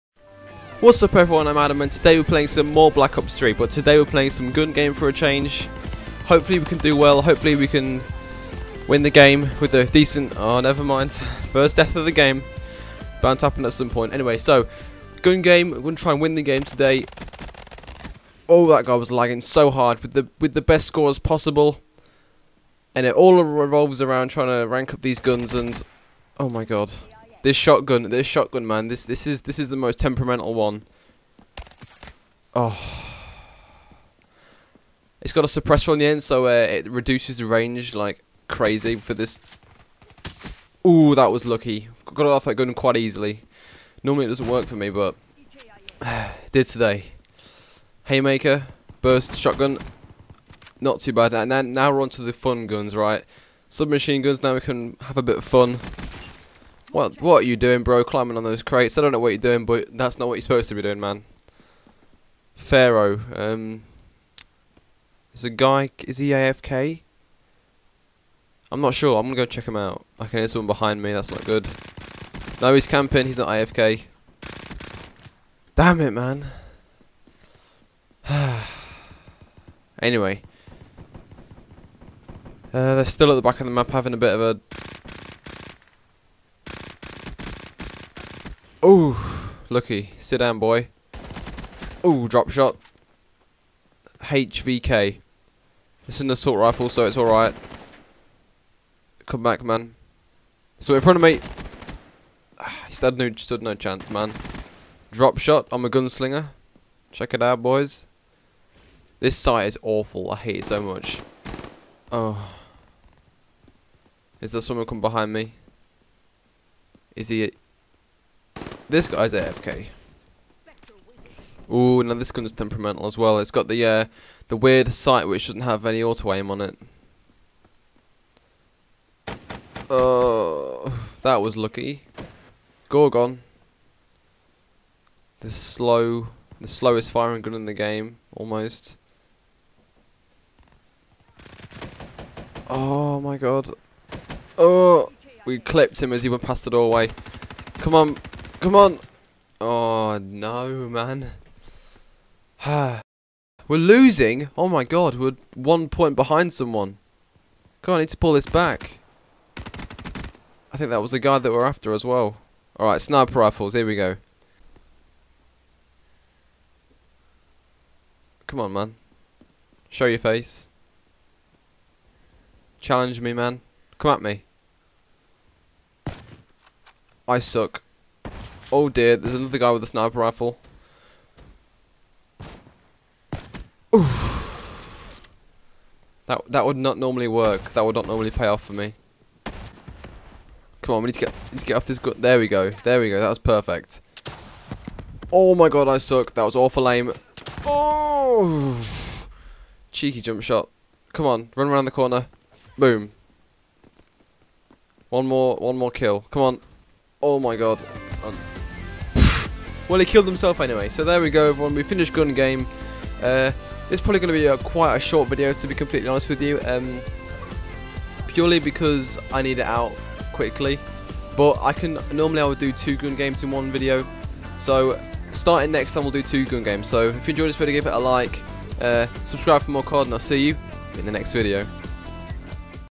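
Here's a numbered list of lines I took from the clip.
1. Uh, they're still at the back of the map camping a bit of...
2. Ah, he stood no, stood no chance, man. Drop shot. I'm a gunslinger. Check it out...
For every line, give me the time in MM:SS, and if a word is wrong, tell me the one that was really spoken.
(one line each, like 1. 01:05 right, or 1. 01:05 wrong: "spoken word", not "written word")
1. 01:22 wrong: "having", not "camping"
2. 01:42 right.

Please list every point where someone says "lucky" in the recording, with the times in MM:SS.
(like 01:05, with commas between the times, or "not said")
00:41, 02:11.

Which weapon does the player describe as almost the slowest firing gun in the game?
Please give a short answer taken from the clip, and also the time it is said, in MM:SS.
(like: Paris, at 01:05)
Gorgon, at 02:12.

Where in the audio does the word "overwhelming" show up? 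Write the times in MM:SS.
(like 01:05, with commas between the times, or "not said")
not said.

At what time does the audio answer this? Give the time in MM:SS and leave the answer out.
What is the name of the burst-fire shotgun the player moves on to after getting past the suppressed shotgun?
00:48.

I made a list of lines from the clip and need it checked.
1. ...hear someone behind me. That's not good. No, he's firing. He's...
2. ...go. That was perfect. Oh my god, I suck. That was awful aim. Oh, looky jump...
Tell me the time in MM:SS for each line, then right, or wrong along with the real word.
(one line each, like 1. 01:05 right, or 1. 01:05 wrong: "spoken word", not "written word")
1. 01:10 wrong: "camping", not "firing"
2. 03:13 wrong: "cheeky", not "looky".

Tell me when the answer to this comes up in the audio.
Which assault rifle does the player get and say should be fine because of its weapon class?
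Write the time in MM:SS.
01:34.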